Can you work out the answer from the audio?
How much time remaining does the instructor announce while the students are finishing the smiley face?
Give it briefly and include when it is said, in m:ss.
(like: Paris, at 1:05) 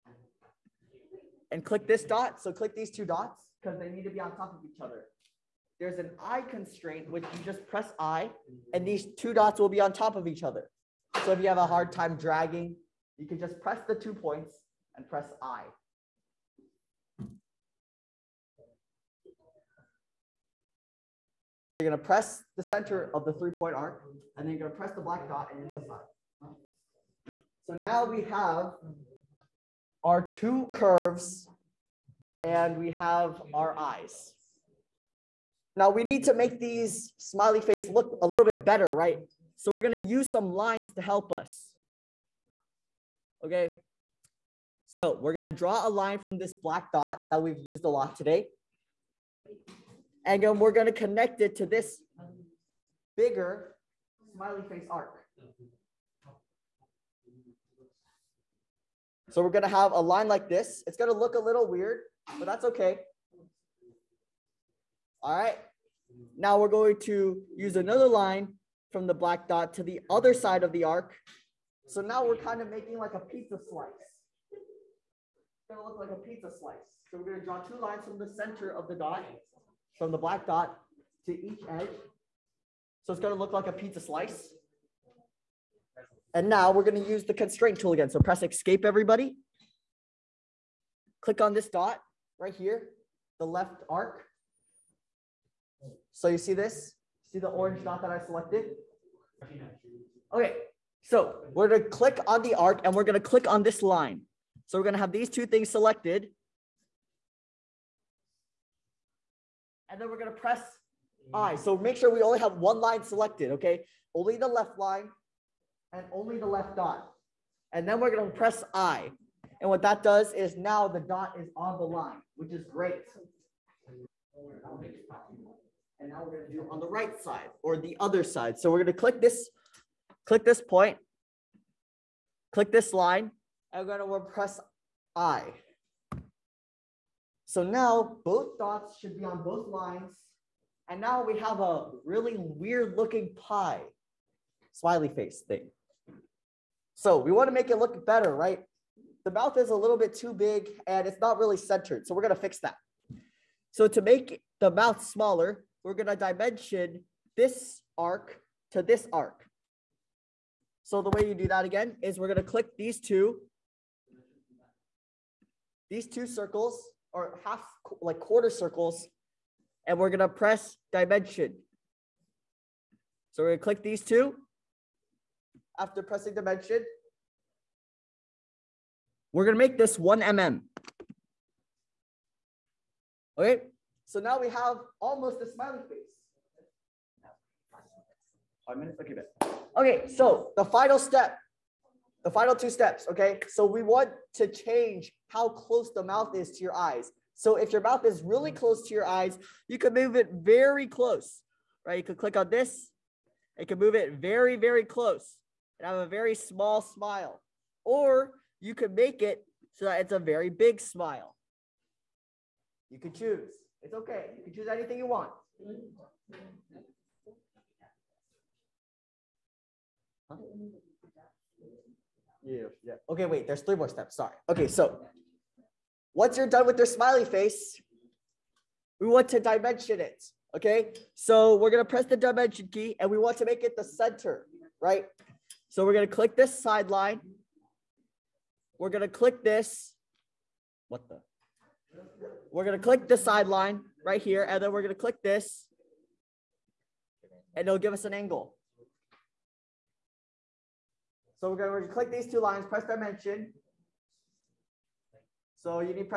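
Five minutes, at 3:08.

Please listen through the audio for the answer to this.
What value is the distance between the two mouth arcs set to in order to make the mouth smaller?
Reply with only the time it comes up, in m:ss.
2:59.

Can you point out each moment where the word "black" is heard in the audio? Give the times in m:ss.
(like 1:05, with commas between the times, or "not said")
0:25, 0:46, 1:09, 1:20.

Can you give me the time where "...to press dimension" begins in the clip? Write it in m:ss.
2:50.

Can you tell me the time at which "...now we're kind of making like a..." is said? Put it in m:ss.
1:12.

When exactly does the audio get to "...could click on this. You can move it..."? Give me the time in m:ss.
3:22.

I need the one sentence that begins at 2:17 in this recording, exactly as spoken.
So now both dots should be on both lines.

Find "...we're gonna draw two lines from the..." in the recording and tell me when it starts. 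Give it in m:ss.
1:17.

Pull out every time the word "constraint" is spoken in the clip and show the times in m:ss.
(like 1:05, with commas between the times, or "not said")
0:06, 1:27.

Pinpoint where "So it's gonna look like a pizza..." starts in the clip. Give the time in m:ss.
1:23.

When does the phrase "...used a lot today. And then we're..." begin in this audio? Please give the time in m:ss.
0:47.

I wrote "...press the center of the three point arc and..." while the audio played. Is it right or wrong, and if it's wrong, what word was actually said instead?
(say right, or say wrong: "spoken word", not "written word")
right.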